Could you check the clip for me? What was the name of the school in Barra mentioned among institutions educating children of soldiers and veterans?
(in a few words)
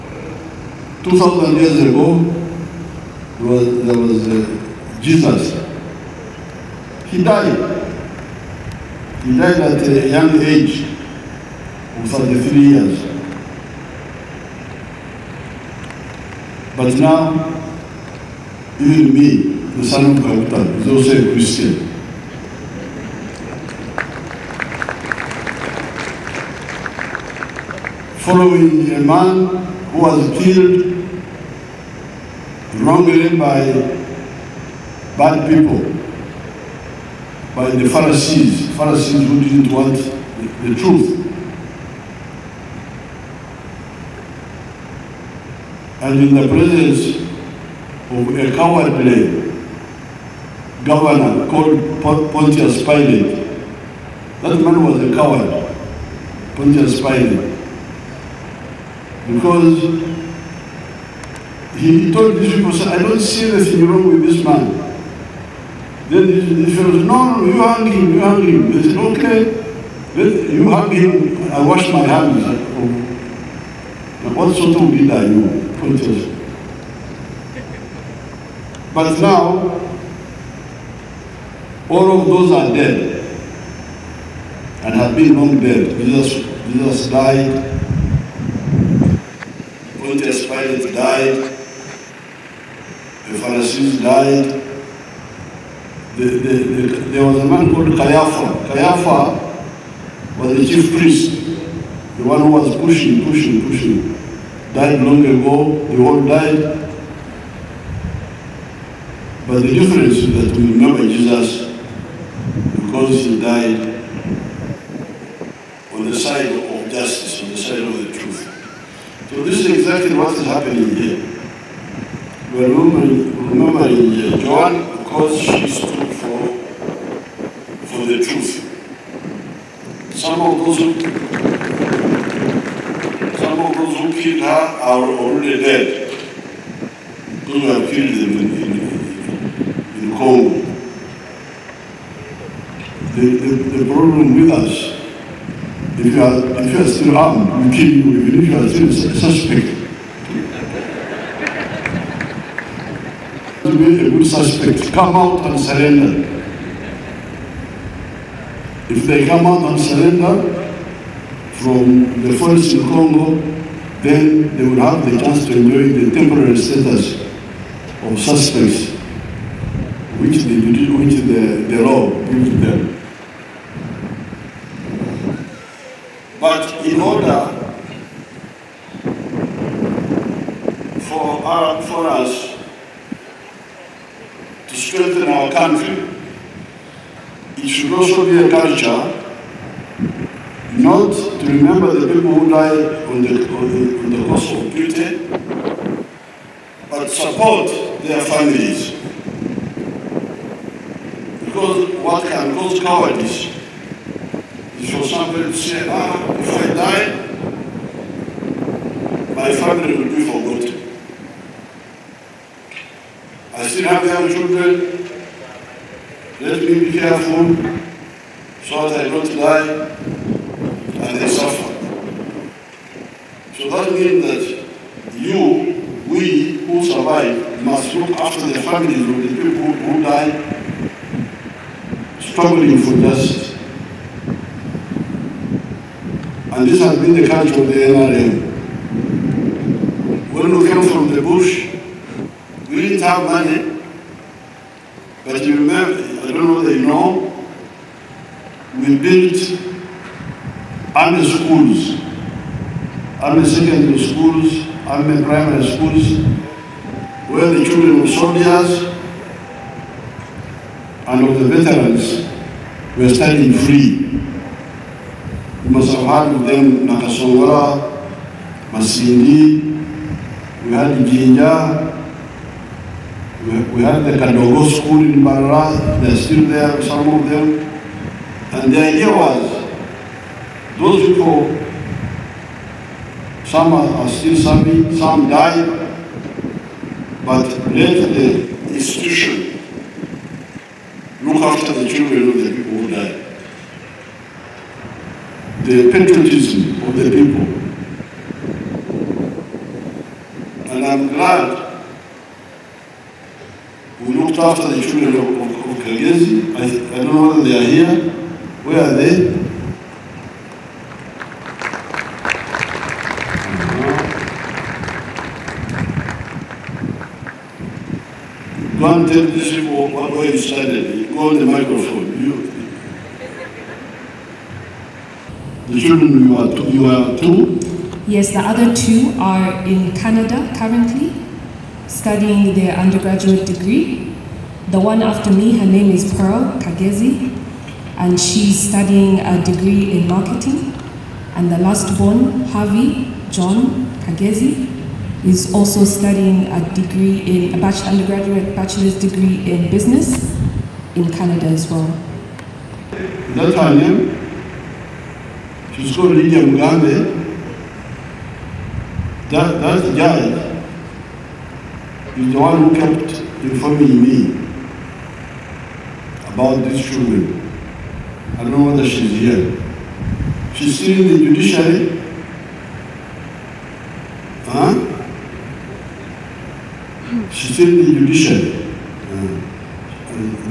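Kadogo school.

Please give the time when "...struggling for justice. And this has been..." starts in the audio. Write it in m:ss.
3:52.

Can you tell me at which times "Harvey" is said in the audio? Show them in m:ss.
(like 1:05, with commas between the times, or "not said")
5:42.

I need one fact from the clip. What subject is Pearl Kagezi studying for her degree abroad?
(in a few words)
Marketing.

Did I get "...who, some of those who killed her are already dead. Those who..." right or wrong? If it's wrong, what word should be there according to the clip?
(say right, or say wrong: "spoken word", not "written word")
right.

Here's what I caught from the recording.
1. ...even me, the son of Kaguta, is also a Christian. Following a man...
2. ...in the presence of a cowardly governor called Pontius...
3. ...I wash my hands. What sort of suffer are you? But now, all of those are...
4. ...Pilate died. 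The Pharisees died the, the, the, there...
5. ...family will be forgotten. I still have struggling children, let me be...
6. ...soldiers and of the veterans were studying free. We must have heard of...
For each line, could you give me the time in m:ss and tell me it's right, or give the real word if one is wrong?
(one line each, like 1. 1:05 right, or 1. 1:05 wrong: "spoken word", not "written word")
1. 0:18 right
2. 0:46 right
3. 1:11 wrong: "leader", not "suffer"
4. 1:30 right
5. 3:29 wrong: "young", not "struggling"
6. 4:18 right.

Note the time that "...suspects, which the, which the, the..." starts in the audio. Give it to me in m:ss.
2:48.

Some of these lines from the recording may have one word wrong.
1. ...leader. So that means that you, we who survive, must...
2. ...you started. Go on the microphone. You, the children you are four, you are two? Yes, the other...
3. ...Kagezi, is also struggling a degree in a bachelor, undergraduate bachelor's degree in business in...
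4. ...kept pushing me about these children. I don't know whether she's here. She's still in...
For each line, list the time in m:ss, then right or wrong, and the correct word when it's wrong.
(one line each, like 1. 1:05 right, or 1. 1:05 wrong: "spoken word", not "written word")
1. 3:41 wrong: "suffer", not "leader"
2. 5:20 wrong: "two", not "four"
3. 5:44 wrong: "studying", not "struggling"
4. 6:02 wrong: "informing", not "pushing".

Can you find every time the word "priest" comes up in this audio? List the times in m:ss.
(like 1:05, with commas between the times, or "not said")
1:40.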